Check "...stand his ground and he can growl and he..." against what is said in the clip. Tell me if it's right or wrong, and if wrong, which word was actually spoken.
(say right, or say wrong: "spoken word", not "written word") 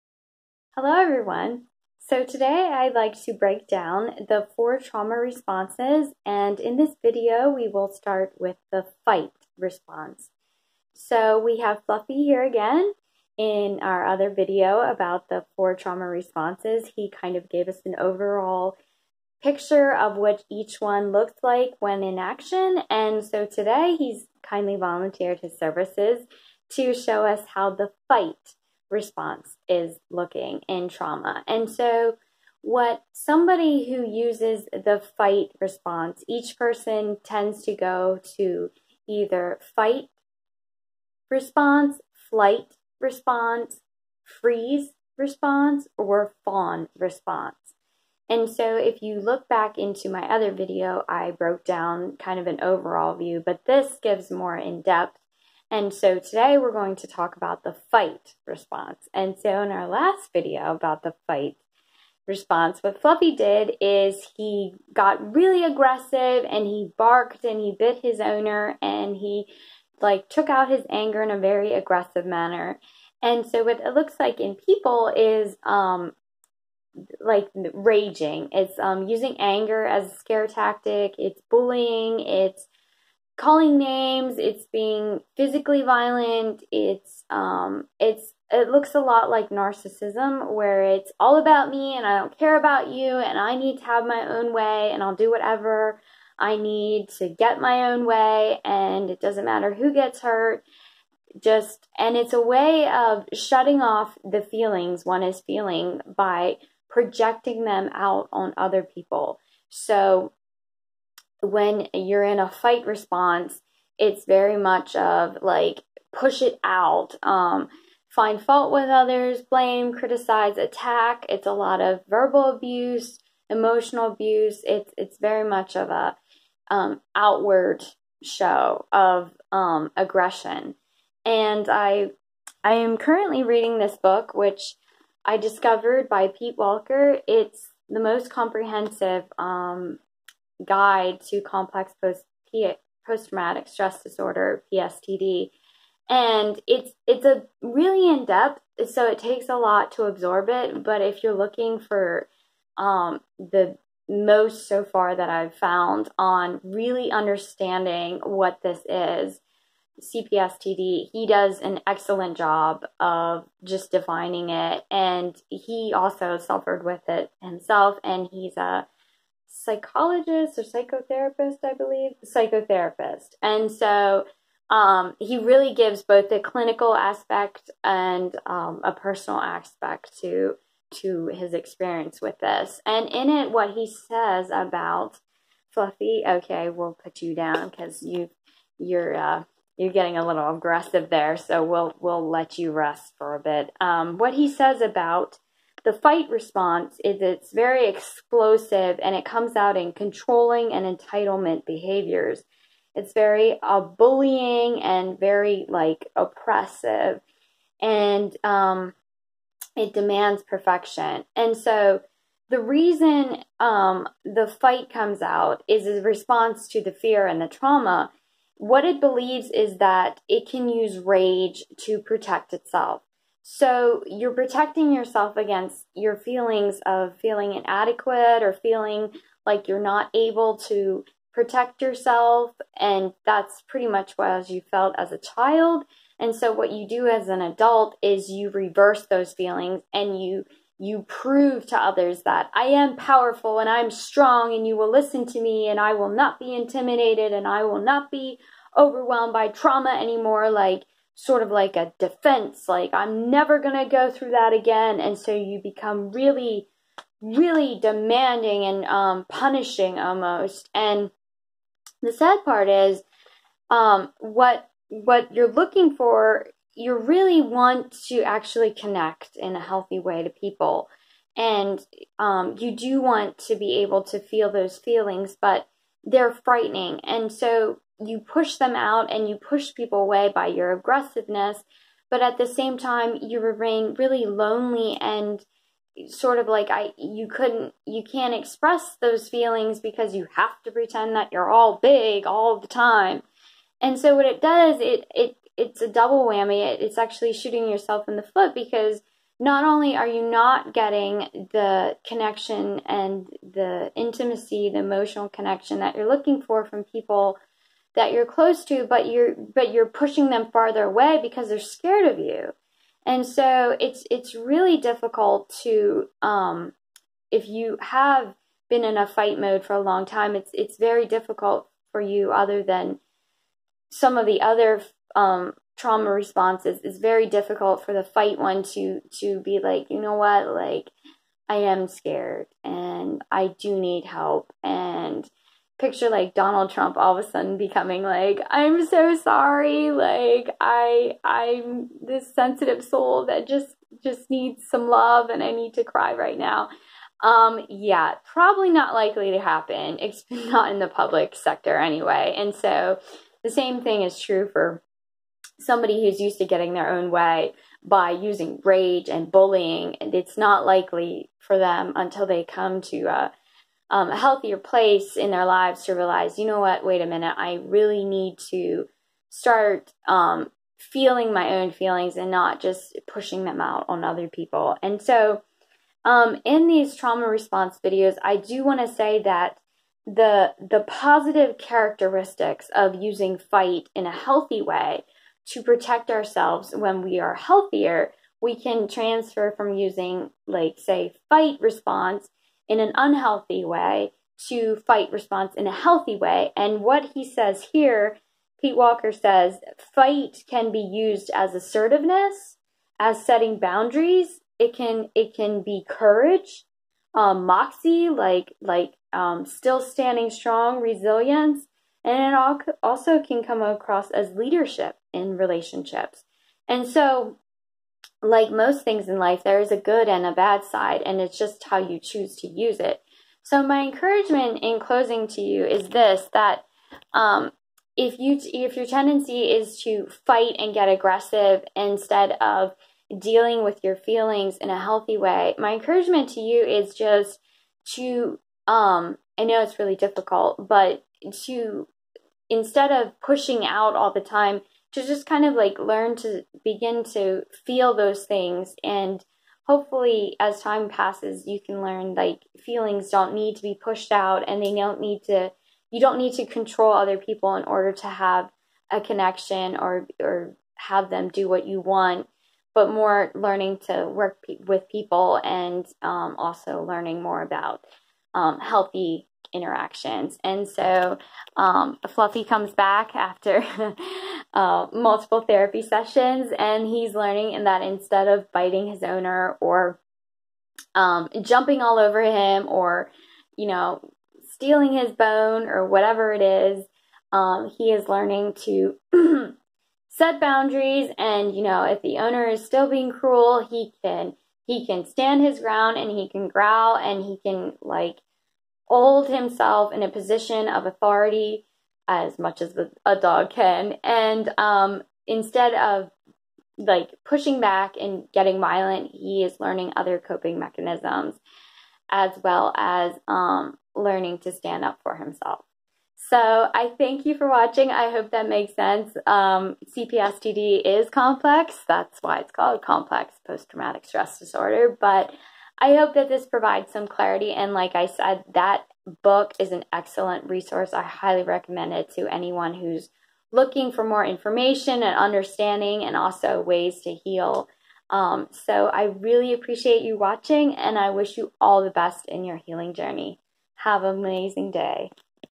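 right.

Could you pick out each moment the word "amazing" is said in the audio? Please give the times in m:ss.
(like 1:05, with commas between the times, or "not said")
9:04.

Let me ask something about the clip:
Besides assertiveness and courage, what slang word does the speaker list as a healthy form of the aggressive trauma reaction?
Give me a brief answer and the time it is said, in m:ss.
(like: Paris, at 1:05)
moxie, at 6:47.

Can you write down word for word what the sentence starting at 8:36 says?
So I thank you for watching.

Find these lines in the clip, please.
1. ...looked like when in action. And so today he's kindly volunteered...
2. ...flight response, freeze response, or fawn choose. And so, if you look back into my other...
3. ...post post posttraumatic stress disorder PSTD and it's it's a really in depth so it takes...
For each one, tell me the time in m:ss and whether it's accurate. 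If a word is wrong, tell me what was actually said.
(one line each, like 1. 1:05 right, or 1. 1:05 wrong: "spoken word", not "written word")
1. 0:21 right
2. 0:42 wrong: "response", not "choose"
3. 2:22 wrong: "traumatic", not "posttraumatic".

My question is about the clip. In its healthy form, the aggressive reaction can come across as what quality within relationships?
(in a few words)
leadership.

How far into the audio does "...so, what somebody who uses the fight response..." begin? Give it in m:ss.
0:31.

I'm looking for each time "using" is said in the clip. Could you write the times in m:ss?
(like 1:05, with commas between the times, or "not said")
1:19, 5:58, 6:22, 6:29.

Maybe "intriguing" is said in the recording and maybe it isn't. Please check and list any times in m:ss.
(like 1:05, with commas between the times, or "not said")
not said.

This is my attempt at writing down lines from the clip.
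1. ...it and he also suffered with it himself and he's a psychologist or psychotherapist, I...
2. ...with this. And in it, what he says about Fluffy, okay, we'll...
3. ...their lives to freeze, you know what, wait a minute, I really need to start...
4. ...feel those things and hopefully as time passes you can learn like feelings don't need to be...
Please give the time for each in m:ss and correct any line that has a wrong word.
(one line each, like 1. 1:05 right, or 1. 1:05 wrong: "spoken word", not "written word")
1. 2:44 right
2. 3:02 right
3. 6:05 wrong: "realize", not "freeze"
4. 7:27 right.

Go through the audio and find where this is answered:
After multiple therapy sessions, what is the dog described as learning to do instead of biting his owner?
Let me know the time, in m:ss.
8:10.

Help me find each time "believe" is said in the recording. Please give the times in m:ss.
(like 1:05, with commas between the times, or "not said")
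2:51, 3:38.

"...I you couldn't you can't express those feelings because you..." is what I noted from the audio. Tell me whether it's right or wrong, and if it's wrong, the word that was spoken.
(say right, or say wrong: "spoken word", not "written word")
right.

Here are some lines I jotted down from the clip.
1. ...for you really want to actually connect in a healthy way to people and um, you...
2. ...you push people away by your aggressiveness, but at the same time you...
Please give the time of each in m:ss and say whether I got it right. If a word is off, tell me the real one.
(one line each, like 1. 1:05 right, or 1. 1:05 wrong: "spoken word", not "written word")
1. 4:25 right
2. 4:39 right.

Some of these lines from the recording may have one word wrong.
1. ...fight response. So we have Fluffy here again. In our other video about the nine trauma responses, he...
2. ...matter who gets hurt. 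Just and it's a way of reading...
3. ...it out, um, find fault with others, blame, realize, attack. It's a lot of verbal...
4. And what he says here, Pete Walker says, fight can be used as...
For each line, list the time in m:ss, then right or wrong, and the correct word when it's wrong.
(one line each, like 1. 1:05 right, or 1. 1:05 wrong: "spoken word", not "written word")
1. 0:09 wrong: "four", not "nine"
2. 1:39 wrong: "shutting", not "reading"
3. 1:56 wrong: "criticize", not "realize"
4. 6:36 right.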